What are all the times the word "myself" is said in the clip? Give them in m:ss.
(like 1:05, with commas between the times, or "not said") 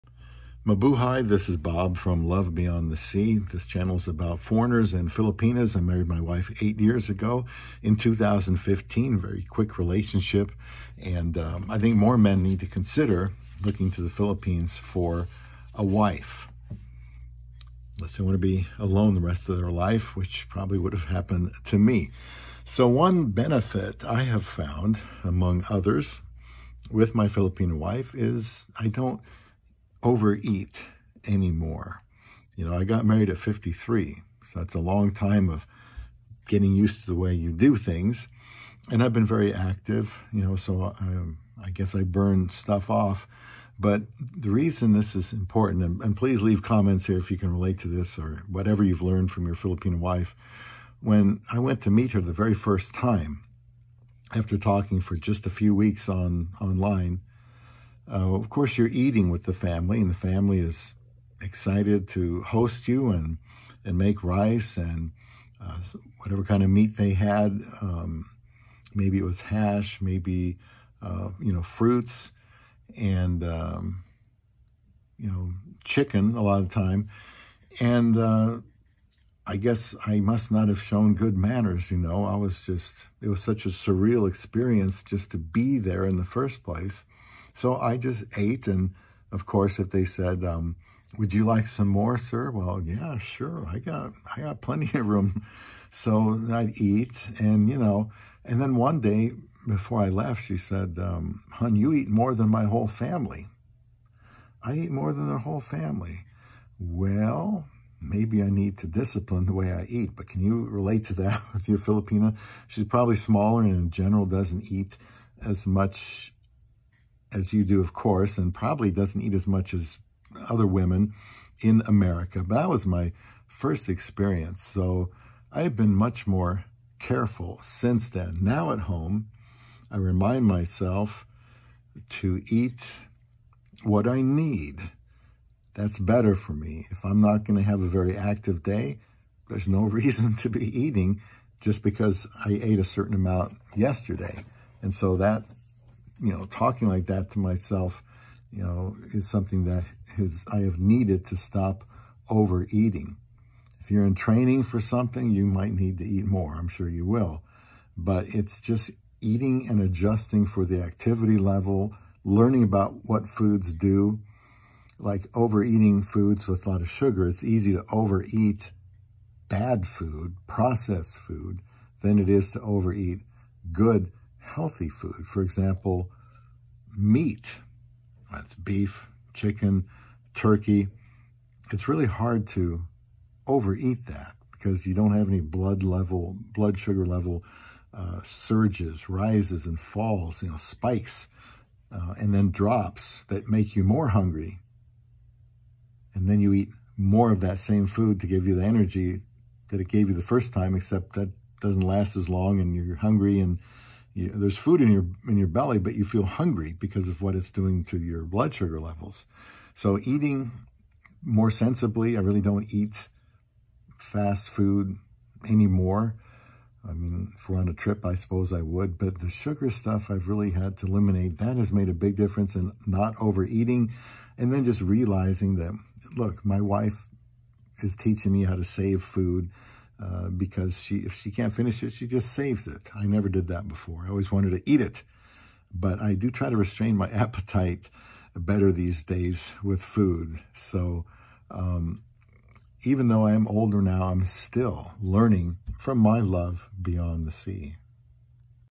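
2:10, 2:27.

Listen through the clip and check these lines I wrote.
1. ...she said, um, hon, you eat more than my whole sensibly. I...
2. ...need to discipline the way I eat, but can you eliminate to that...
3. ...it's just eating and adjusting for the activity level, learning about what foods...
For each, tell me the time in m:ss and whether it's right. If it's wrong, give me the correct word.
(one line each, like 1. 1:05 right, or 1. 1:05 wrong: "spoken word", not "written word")
1. 1:40 wrong: "family", not "sensibly"
2. 1:48 wrong: "relate", not "eliminate"
3. 2:38 right.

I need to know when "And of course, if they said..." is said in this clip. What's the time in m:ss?
1:28.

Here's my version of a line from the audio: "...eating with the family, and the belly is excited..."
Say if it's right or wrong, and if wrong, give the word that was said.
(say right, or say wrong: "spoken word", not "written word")
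wrong: "family", not "belly".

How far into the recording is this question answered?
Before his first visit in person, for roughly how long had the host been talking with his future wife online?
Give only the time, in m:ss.
0:55.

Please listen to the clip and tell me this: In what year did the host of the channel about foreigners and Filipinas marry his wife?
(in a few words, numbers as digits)
2015.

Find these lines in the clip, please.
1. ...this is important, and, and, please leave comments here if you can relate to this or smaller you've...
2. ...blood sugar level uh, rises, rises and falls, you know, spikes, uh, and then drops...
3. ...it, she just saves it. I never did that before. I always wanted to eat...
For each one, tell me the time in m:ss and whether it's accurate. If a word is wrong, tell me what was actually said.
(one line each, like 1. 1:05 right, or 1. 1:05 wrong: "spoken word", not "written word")
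1. 0:44 wrong: "whatever", not "smaller"
2. 3:06 wrong: "surges", not "rises"
3. 3:51 right.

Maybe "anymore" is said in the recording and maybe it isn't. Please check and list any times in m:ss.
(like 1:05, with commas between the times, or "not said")
0:31, 3:35.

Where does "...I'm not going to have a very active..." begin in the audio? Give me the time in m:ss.
2:17.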